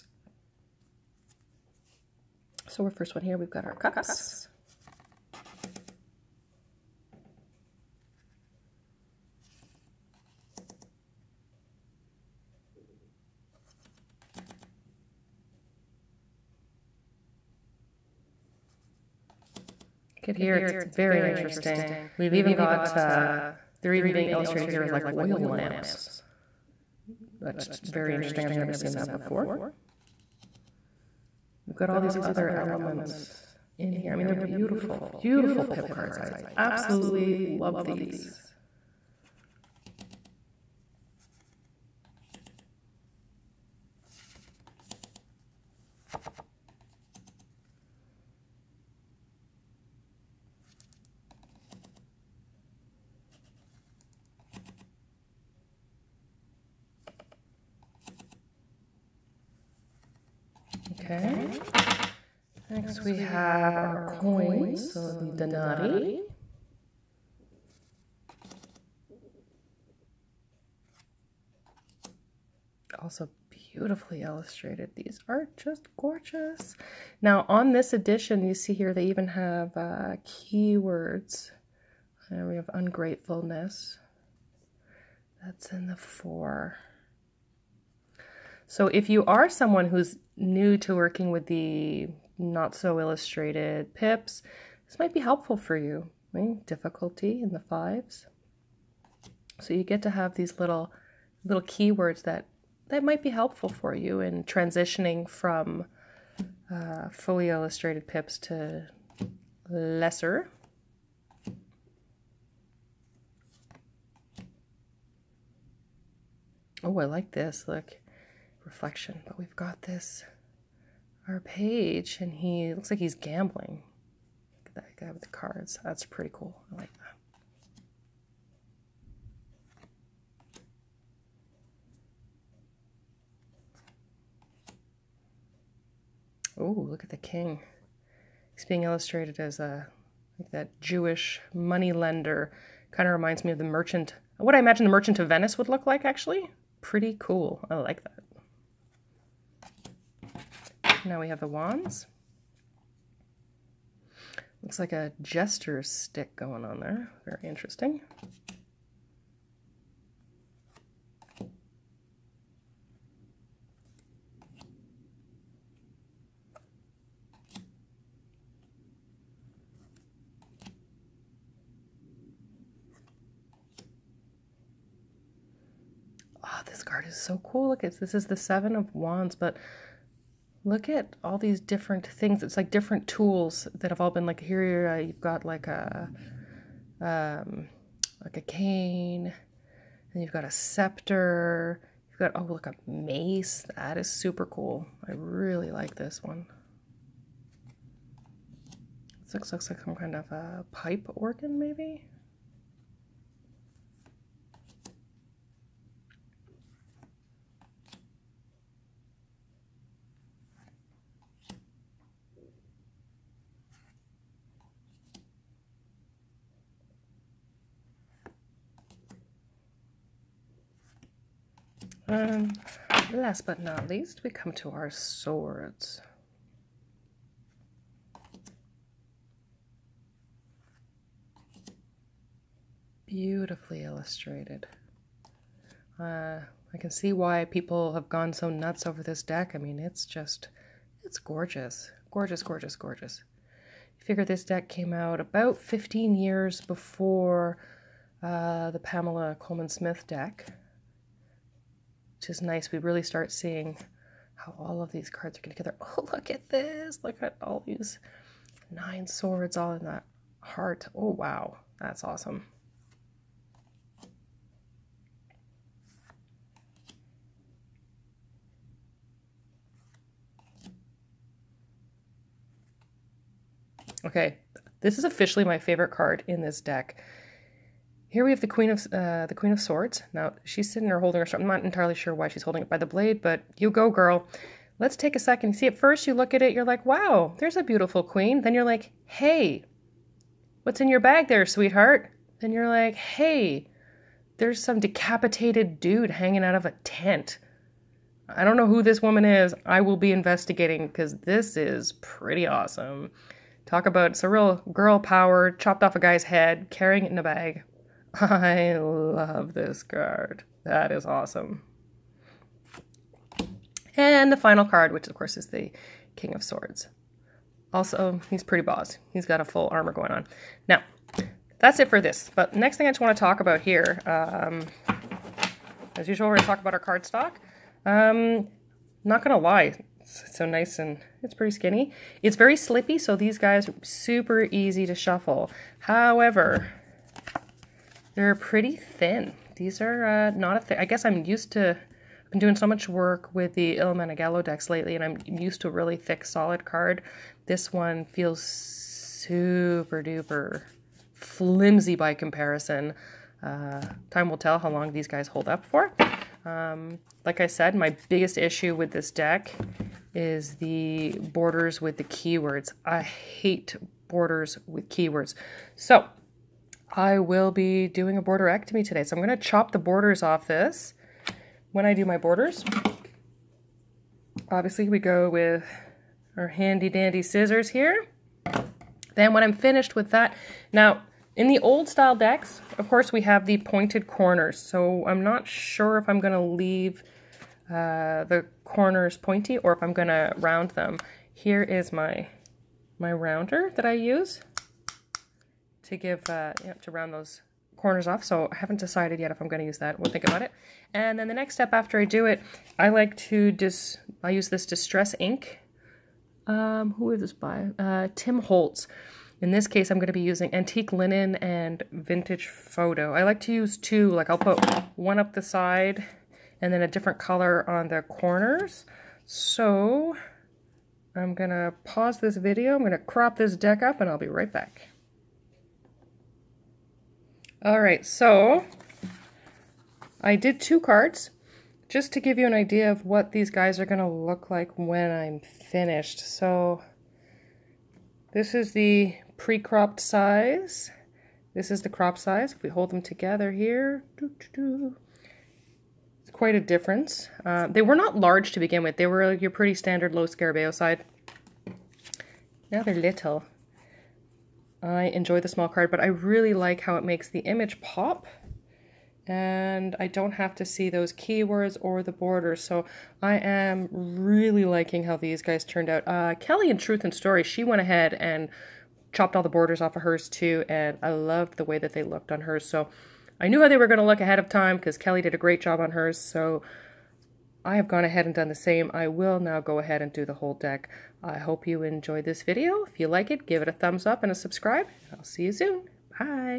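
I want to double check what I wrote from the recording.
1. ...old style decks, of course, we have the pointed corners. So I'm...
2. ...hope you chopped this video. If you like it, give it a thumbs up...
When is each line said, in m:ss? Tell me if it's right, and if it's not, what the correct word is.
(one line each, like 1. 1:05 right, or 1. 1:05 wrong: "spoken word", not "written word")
1. 6:21 right
2. 8:01 wrong: "enjoyed", not "chopped".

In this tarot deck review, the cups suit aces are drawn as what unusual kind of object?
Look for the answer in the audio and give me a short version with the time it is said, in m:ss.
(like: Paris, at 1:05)
Oil lamps, at 0:25.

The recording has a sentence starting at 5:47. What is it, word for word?
This one feels super duper flimsy by comparison.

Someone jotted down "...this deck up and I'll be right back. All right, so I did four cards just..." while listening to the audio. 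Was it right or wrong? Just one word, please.
wrong.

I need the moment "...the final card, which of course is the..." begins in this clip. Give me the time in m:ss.
5:14.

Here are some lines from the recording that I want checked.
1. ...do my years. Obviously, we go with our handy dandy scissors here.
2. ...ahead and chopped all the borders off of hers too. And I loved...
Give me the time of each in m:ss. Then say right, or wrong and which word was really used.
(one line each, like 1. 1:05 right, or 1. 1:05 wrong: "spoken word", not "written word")
1. 6:11 wrong: "borders", not "years"
2. 7:47 right.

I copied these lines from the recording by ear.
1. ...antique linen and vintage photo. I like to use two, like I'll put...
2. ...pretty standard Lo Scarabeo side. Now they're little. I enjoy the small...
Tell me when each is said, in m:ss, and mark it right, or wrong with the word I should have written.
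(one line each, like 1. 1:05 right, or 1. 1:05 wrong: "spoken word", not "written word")
1. 6:50 right
2. 7:29 right.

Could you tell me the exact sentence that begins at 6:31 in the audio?
Here is my, my rounder that I use to give, uh, you know, to round those corners off.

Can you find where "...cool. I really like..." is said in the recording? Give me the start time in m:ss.
3:14.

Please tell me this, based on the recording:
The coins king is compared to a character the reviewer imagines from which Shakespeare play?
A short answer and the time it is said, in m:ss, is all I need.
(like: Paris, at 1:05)
The Merchant of Venice, at 2:24.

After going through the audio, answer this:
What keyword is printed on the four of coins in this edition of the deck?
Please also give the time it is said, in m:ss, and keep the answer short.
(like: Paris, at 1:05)
Ungratefulness, at 1:22.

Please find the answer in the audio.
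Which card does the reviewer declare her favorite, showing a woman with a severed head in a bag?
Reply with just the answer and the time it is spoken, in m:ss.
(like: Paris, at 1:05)
Queen of Swords, at 4:39.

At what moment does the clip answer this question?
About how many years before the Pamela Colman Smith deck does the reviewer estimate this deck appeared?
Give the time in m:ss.
4:05.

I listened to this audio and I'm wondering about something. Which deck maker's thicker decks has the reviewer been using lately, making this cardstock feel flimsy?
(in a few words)
Il Meneghello.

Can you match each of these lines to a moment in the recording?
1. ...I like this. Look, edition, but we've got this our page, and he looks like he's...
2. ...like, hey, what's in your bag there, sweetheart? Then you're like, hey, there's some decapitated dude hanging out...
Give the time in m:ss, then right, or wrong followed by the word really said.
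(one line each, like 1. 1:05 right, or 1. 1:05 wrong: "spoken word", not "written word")
1. 1:56 wrong: "reflection", not "edition"
2. 4:48 right.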